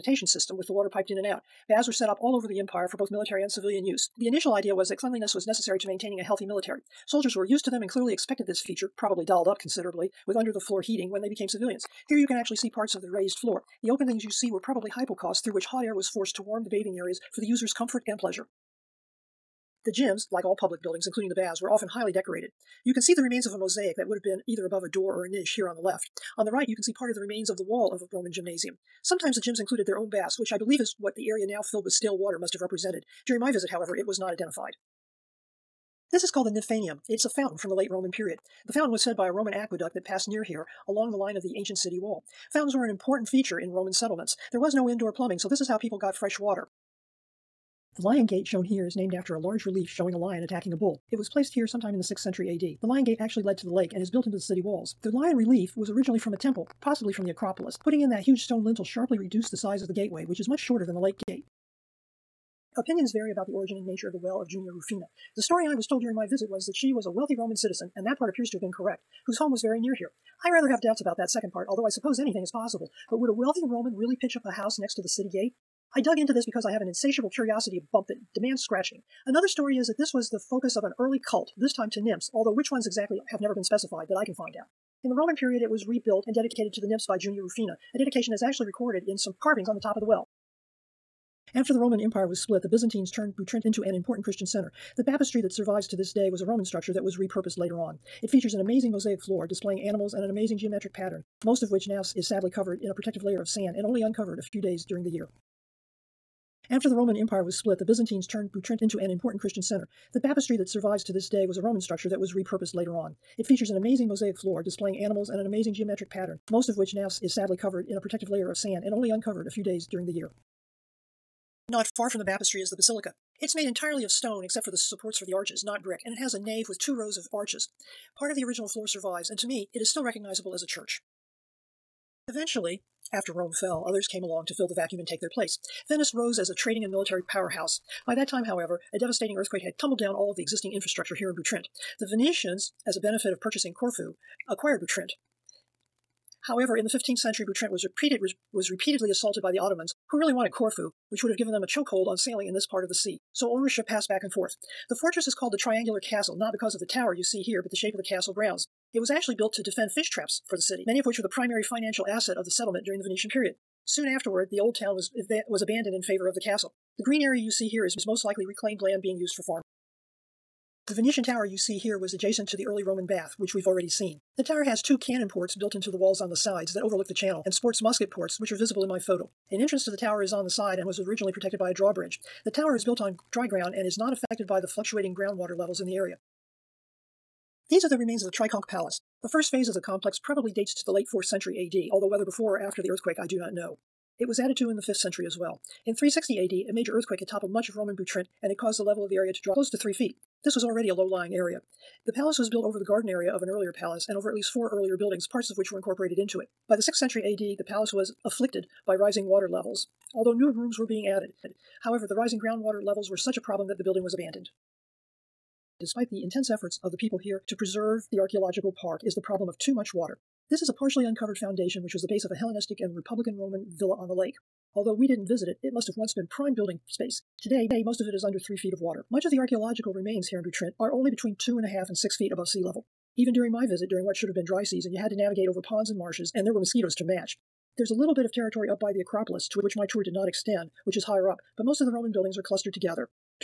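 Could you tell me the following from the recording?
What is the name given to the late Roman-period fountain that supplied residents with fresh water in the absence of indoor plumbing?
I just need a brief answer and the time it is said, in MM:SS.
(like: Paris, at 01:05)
Nymphanium, at 00:36.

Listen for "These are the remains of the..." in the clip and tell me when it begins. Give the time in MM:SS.
03:07.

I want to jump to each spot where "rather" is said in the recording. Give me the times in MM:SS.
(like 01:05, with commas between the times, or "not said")
01:10.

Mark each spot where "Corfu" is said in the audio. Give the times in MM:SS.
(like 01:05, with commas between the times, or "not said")
02:23, 02:30.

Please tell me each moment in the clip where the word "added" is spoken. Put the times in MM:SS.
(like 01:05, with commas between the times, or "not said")
03:14, 03:31.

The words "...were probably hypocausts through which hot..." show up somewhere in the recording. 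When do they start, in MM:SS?
00:14.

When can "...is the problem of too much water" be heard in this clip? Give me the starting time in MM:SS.
03:39.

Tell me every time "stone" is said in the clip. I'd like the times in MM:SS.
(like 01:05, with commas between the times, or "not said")
00:58, 02:04.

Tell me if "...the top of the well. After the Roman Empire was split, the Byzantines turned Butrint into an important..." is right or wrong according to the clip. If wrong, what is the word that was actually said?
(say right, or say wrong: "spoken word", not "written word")
right.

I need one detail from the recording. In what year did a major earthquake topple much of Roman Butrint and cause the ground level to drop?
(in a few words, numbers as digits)
360 AD.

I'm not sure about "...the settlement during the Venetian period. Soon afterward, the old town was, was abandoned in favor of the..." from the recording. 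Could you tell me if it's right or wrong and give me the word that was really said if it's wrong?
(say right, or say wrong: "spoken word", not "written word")
right.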